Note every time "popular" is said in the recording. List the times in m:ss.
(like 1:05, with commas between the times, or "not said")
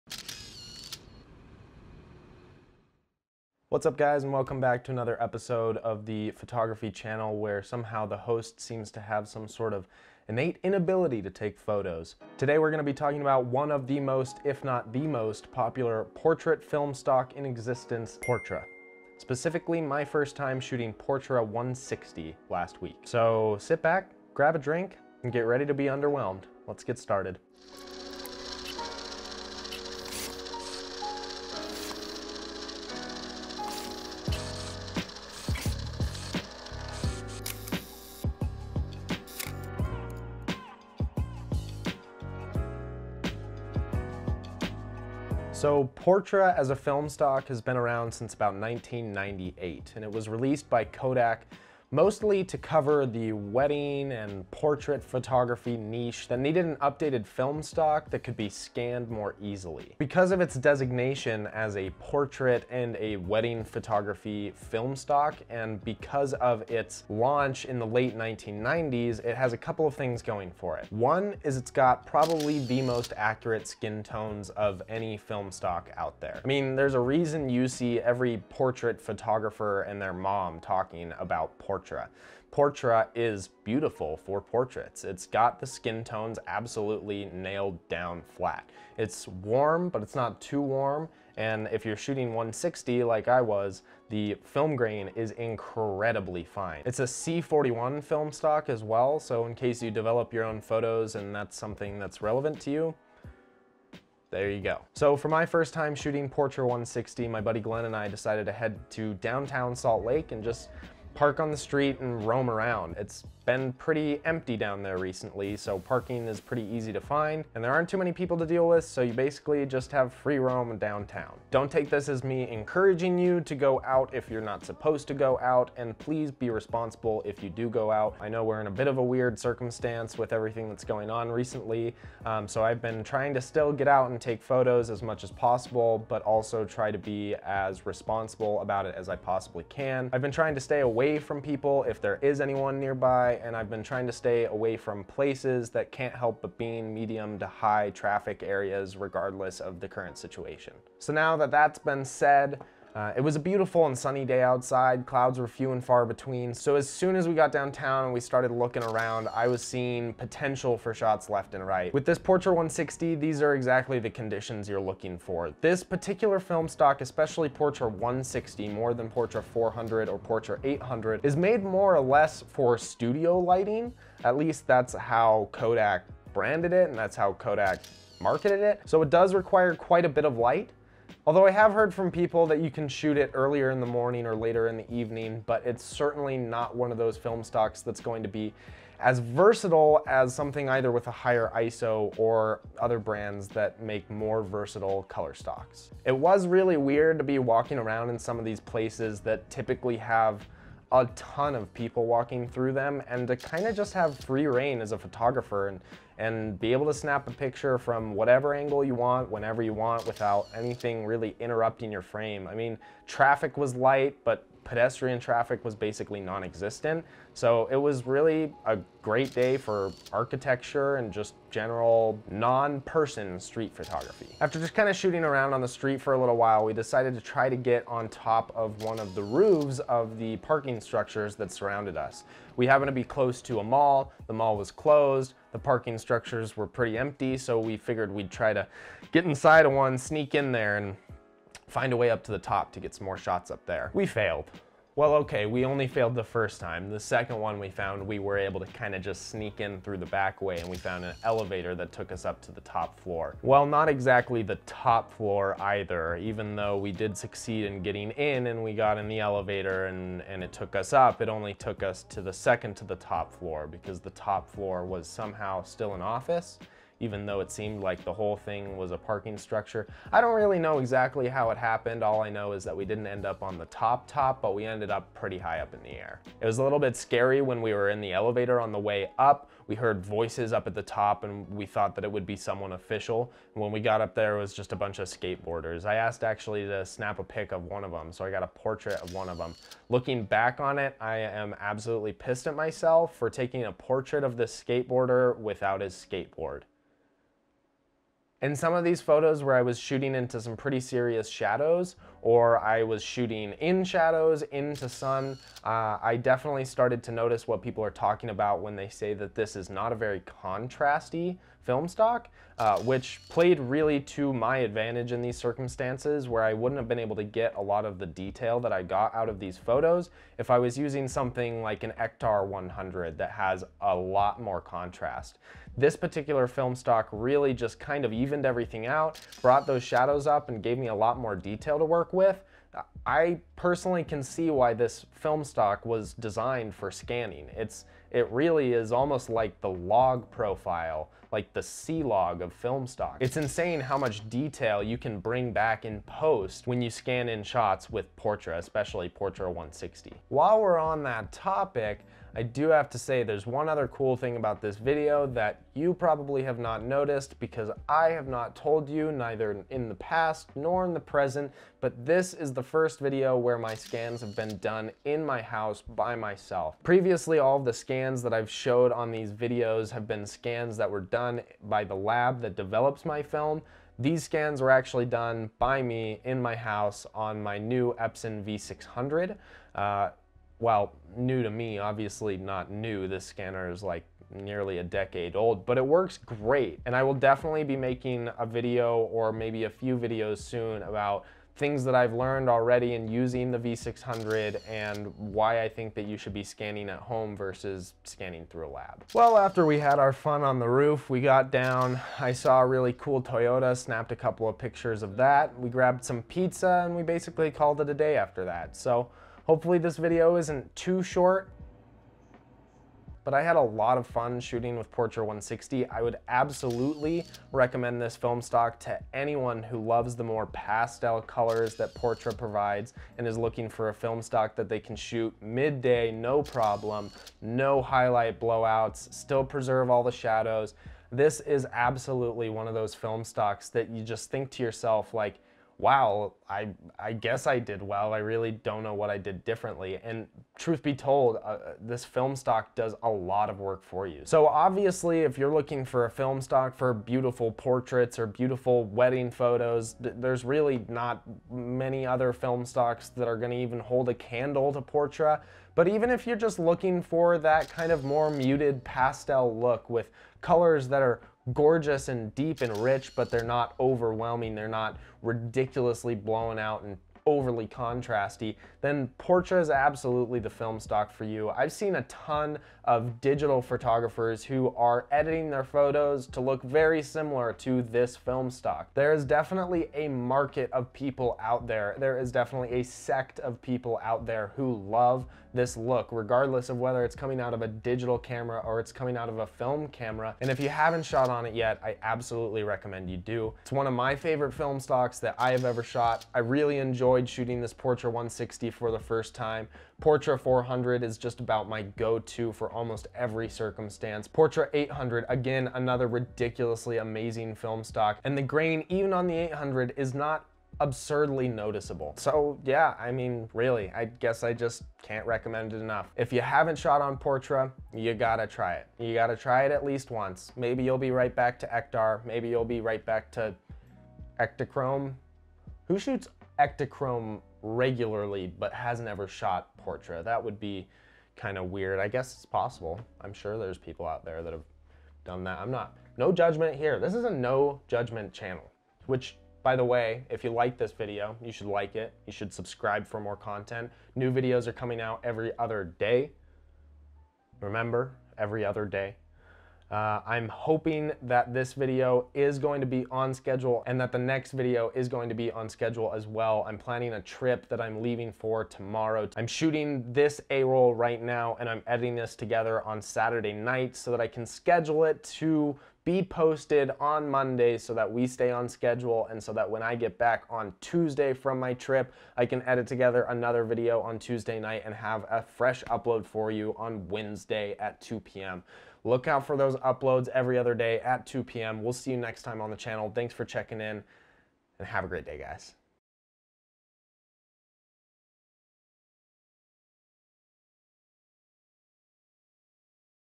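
0:15.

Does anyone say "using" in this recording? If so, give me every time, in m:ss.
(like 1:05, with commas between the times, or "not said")
5:20, 6:33.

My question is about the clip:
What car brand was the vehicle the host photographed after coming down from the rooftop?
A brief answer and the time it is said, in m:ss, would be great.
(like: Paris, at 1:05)
Toyota, at 6:43.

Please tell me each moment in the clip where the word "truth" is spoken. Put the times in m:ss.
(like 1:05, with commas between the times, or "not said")
7:20.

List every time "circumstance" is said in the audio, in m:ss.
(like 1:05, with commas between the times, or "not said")
2:09, 5:15, 8:23.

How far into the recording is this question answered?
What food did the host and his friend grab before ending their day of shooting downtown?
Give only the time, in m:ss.
6:46.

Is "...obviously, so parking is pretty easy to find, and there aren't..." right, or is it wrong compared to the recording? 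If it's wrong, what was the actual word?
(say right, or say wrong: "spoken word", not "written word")
wrong: "recently", not "obviously".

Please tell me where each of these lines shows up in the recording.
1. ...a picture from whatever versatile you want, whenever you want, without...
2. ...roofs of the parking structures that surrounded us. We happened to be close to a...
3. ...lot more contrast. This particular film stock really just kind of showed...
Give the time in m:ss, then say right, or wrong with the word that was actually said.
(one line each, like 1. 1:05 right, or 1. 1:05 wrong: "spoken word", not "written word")
1. 3:27 wrong: "angle", not "versatile"
2. 3:49 right
3. 5:23 wrong: "evened", not "showed".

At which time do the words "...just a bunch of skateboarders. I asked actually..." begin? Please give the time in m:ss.
4:44.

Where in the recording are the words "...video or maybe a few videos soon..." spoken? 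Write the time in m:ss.
6:28.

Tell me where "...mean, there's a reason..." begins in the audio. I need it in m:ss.
1:16.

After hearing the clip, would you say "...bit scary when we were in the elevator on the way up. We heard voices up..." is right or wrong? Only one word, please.
right.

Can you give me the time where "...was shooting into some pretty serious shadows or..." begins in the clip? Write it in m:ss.
4:59.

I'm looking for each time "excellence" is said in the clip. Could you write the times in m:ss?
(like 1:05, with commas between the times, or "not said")
not said.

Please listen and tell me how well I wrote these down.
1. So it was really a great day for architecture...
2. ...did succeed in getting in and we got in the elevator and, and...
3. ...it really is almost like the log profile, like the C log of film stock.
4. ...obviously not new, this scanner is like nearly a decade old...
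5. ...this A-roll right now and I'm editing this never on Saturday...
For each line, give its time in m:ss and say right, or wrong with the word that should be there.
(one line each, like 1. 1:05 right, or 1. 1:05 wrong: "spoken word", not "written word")
1. 3:37 right
2. 4:16 right
3. 5:38 right
4. 6:21 right
5. 9:20 wrong: "together", not "never".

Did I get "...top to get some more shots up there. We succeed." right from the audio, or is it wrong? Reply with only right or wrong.
wrong.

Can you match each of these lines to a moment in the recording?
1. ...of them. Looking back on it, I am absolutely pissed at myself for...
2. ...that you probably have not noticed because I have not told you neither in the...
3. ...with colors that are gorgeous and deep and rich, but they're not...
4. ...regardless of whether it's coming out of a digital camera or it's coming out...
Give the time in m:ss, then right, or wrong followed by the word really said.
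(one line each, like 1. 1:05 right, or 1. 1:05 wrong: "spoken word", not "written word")
1. 4:49 right
2. 5:55 right
3. 7:39 right
4. 8:06 right.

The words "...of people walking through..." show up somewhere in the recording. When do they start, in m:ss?
3:21.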